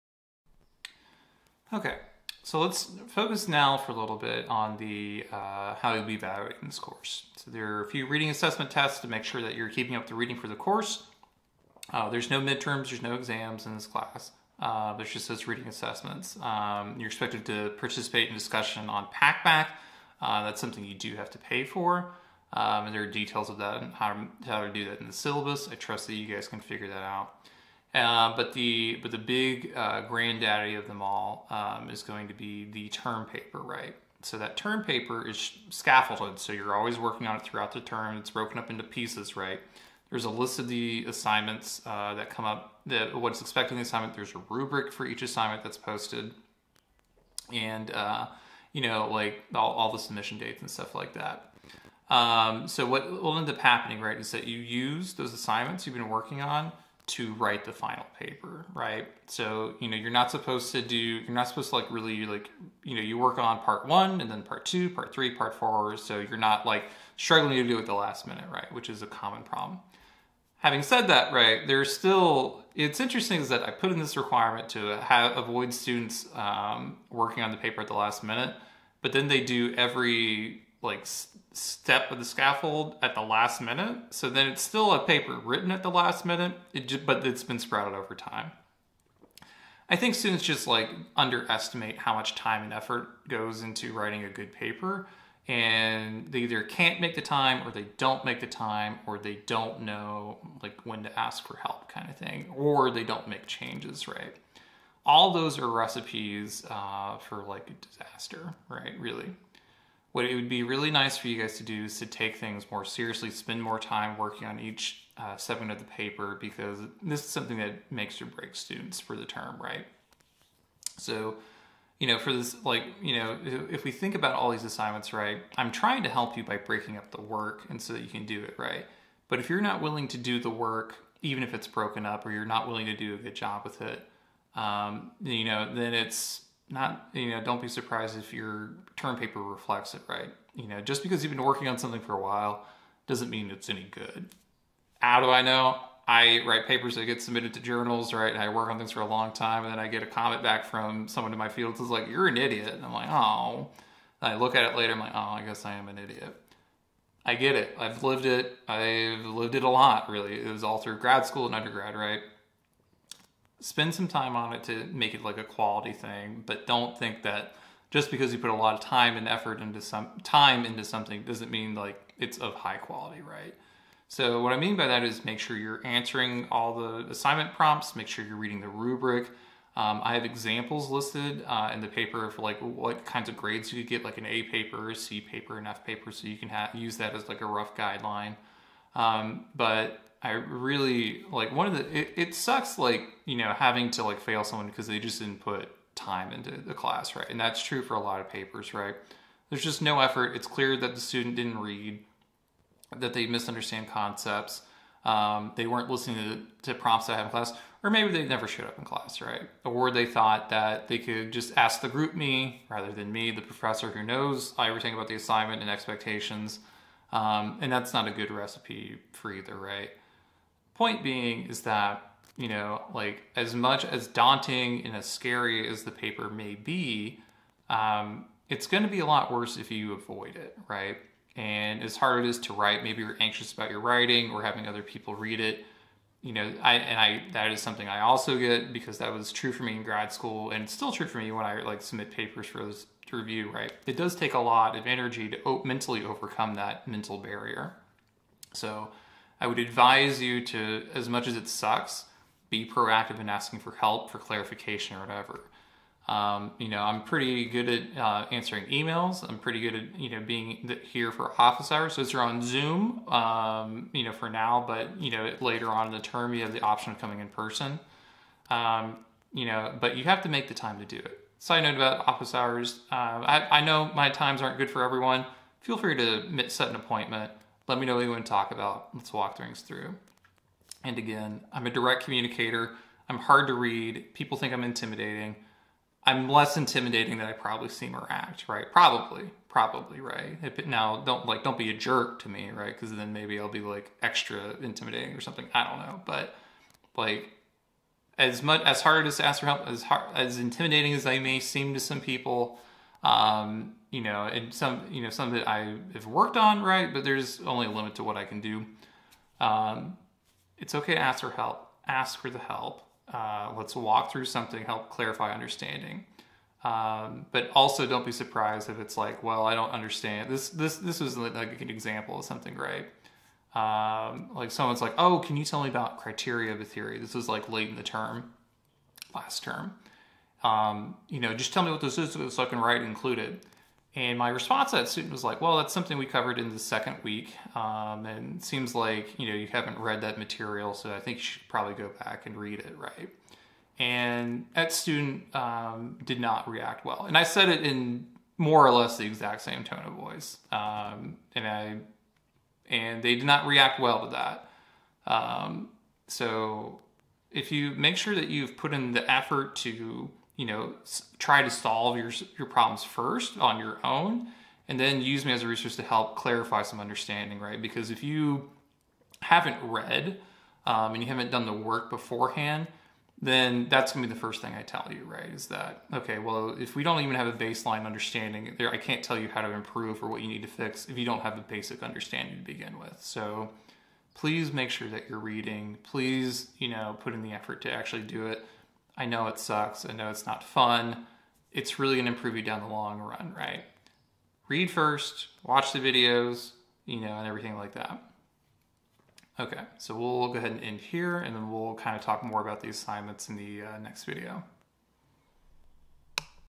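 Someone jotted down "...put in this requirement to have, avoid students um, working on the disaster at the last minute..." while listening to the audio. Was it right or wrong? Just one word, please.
wrong.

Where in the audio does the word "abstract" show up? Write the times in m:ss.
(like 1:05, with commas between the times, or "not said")
not said.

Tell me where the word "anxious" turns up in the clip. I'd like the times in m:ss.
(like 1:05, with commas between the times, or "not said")
3:53.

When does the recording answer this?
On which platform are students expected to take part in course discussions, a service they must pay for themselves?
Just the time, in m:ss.
0:19.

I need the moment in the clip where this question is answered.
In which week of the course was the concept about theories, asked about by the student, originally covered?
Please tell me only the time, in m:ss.
5:36.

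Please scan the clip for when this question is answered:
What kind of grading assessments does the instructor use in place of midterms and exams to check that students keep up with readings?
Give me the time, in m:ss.
0:15.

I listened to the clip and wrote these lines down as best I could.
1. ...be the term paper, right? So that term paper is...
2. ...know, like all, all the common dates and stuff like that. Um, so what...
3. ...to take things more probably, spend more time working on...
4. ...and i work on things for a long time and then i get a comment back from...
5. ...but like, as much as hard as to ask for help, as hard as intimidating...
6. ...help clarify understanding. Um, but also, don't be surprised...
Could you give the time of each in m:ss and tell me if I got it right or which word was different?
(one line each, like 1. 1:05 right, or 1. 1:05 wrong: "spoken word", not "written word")
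1. 0:32 right
2. 0:48 wrong: "submission", not "common"
3. 1:51 wrong: "seriously", not "probably"
4. 2:28 right
5. 4:56 right
6. 5:14 right.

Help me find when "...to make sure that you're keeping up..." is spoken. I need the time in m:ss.
0:09.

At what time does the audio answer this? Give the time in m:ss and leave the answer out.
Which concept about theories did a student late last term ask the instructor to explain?
5:25.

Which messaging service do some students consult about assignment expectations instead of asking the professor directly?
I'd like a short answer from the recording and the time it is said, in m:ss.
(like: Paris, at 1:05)
GroupMe, at 3:31.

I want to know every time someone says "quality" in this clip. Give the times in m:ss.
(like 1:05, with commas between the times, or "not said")
2:45, 2:52.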